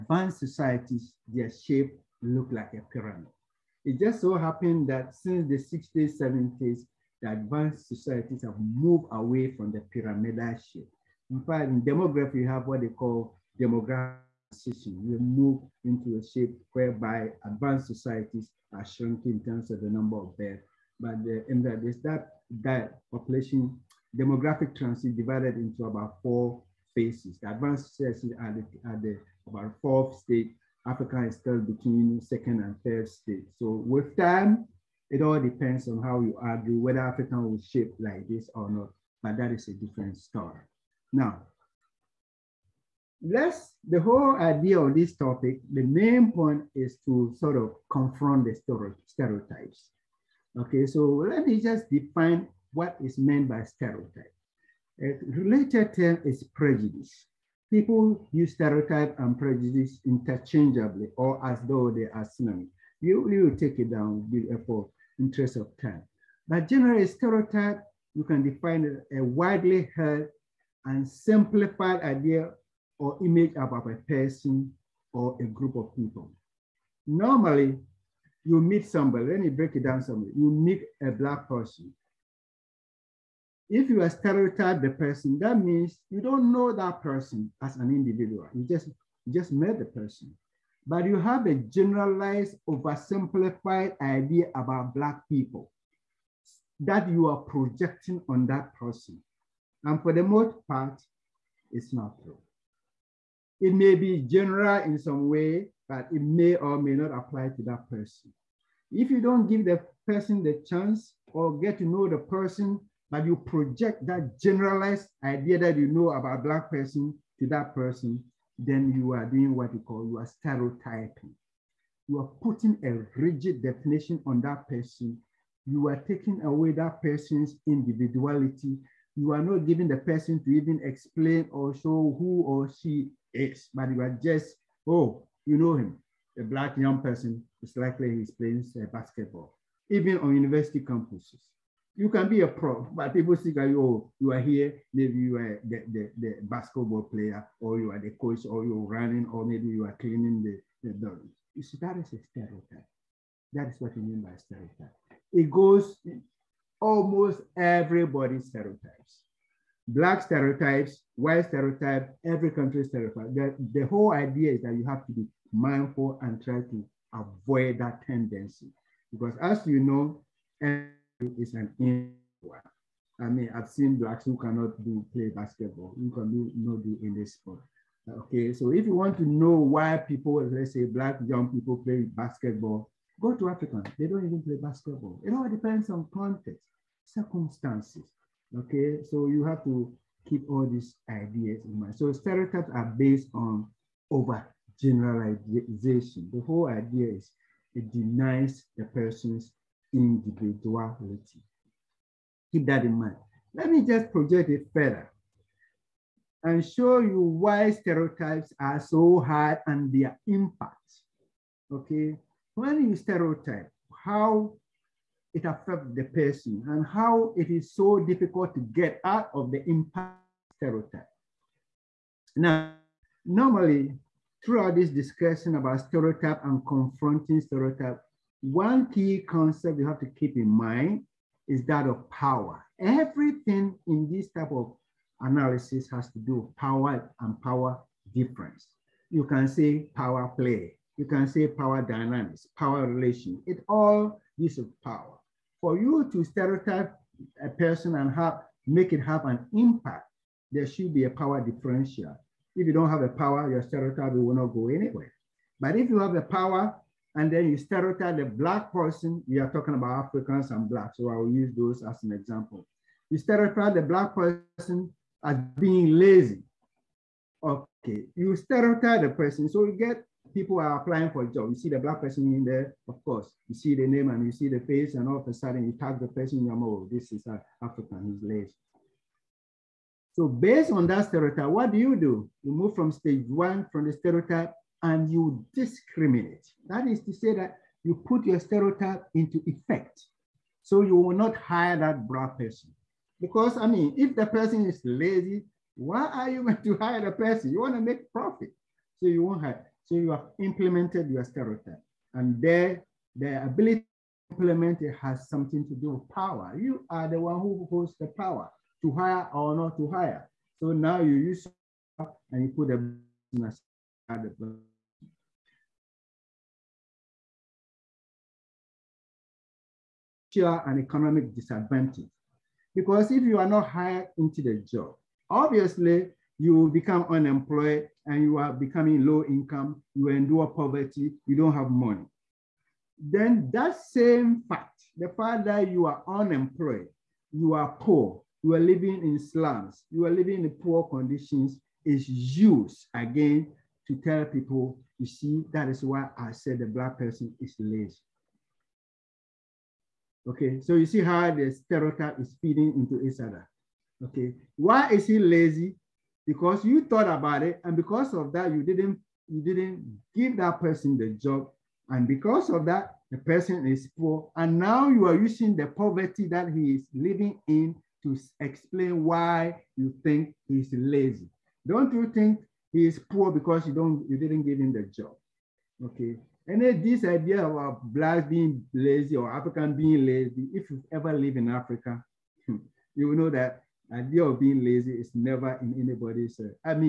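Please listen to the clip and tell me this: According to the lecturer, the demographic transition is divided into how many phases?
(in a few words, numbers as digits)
4.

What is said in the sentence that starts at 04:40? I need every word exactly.
So based on that stereotype, what do you do?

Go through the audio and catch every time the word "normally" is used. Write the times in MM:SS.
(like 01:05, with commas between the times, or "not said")
01:17, 03:43.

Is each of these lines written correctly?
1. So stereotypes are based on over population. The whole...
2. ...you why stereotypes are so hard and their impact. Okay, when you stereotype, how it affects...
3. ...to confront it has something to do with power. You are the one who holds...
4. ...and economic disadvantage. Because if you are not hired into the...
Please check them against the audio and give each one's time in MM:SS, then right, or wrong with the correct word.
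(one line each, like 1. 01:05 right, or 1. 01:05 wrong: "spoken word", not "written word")
1. 03:11 wrong: "generalization", not "population"
2. 03:26 right
3. 05:04 wrong: "implement", not "confront"
4. 05:20 right.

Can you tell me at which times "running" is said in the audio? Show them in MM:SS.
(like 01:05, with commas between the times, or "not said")
02:28.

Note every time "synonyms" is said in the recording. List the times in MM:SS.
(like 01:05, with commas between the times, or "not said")
01:02.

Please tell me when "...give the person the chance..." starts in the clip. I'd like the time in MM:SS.
01:49.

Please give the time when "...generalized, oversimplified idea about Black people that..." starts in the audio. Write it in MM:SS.
01:31.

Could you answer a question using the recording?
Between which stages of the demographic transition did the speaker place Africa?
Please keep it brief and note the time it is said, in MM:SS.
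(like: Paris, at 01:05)
second and third, at 00:32.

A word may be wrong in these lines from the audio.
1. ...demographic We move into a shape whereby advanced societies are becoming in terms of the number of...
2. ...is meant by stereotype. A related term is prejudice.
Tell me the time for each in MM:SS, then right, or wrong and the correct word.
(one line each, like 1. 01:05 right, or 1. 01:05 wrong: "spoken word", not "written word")
1. 00:13 wrong: "shrinking", not "becoming"
2. 00:53 right.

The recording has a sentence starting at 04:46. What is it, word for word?
That is to say that you put your stereotype into effect.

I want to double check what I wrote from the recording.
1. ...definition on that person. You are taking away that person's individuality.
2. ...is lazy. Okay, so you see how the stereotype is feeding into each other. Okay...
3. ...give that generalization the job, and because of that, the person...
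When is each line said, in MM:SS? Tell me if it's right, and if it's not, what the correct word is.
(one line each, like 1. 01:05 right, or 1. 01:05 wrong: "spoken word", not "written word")
1. 02:03 right
2. 05:47 right
3. 06:00 wrong: "person", not "generalization".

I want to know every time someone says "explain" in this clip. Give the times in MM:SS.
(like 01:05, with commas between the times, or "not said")
02:10, 06:08.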